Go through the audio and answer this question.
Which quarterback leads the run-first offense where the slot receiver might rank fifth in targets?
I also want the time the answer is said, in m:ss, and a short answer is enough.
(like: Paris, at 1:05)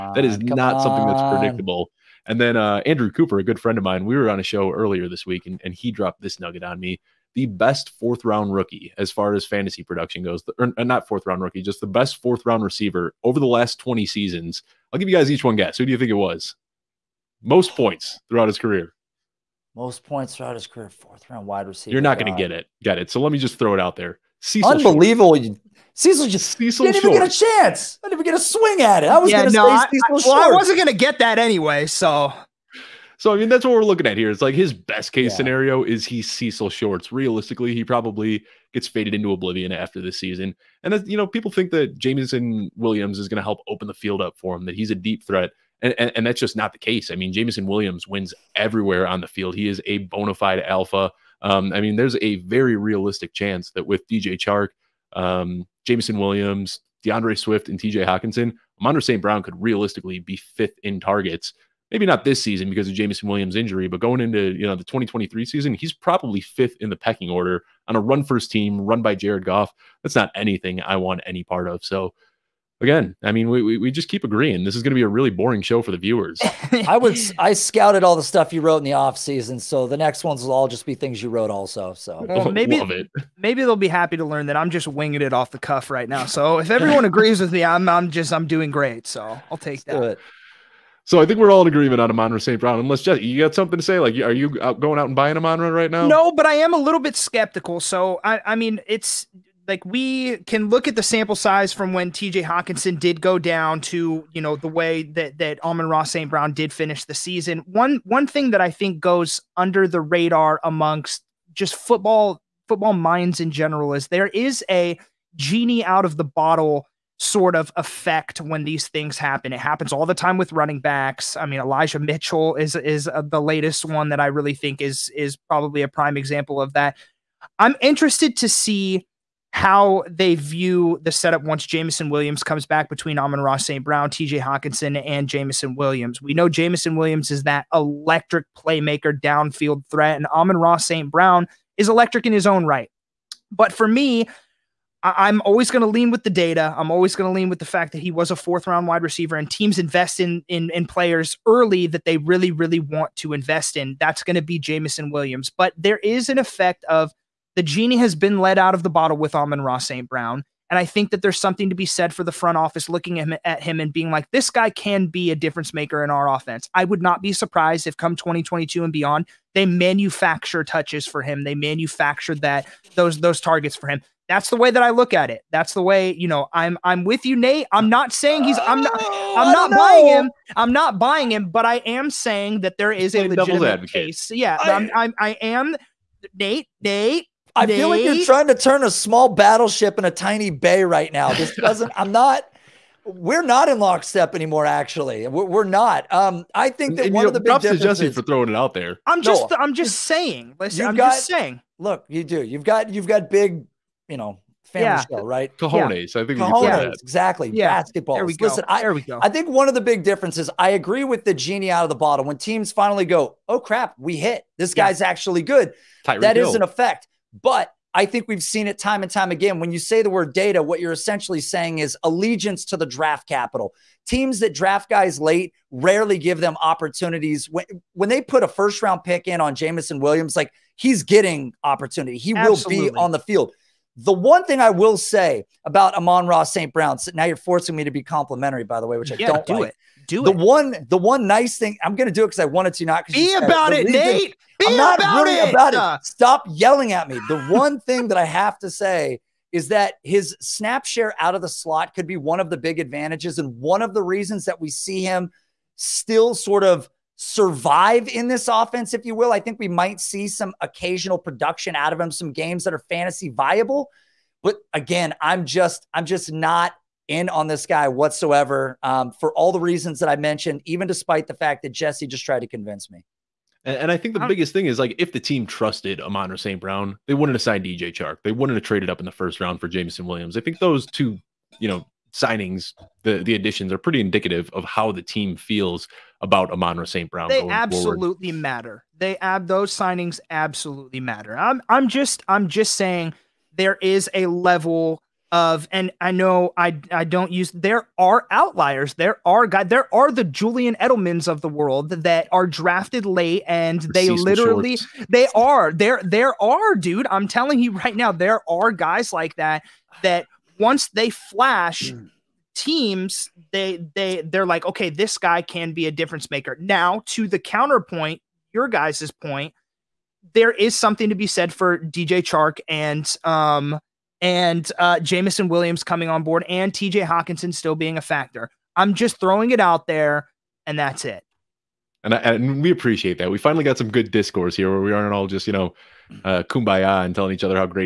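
Jared Goff, at 1:09.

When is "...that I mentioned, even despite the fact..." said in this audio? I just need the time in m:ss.
4:29.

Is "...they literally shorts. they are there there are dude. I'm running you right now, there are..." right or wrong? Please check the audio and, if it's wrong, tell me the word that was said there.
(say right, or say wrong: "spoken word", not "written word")
wrong: "telling", not "running".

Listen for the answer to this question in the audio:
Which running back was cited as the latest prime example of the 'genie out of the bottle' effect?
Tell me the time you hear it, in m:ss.
2:01.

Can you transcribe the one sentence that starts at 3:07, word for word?
feel like you're trying to turn a small battleship in a tiny bay right now.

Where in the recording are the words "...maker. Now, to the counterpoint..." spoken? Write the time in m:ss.
5:16.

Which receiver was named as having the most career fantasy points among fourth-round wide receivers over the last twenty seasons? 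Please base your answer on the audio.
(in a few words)
Cecil Shorts.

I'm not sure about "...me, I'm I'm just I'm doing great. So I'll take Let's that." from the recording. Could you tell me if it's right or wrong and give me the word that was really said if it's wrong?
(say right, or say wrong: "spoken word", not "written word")
right.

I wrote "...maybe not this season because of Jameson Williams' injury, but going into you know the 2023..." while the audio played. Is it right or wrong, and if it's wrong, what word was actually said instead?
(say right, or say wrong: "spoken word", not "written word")
right.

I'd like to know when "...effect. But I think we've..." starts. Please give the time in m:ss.
3:36.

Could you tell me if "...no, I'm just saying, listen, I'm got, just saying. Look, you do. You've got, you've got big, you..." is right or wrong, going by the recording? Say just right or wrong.
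right.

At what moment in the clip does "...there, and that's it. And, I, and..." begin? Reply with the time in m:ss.
5:29.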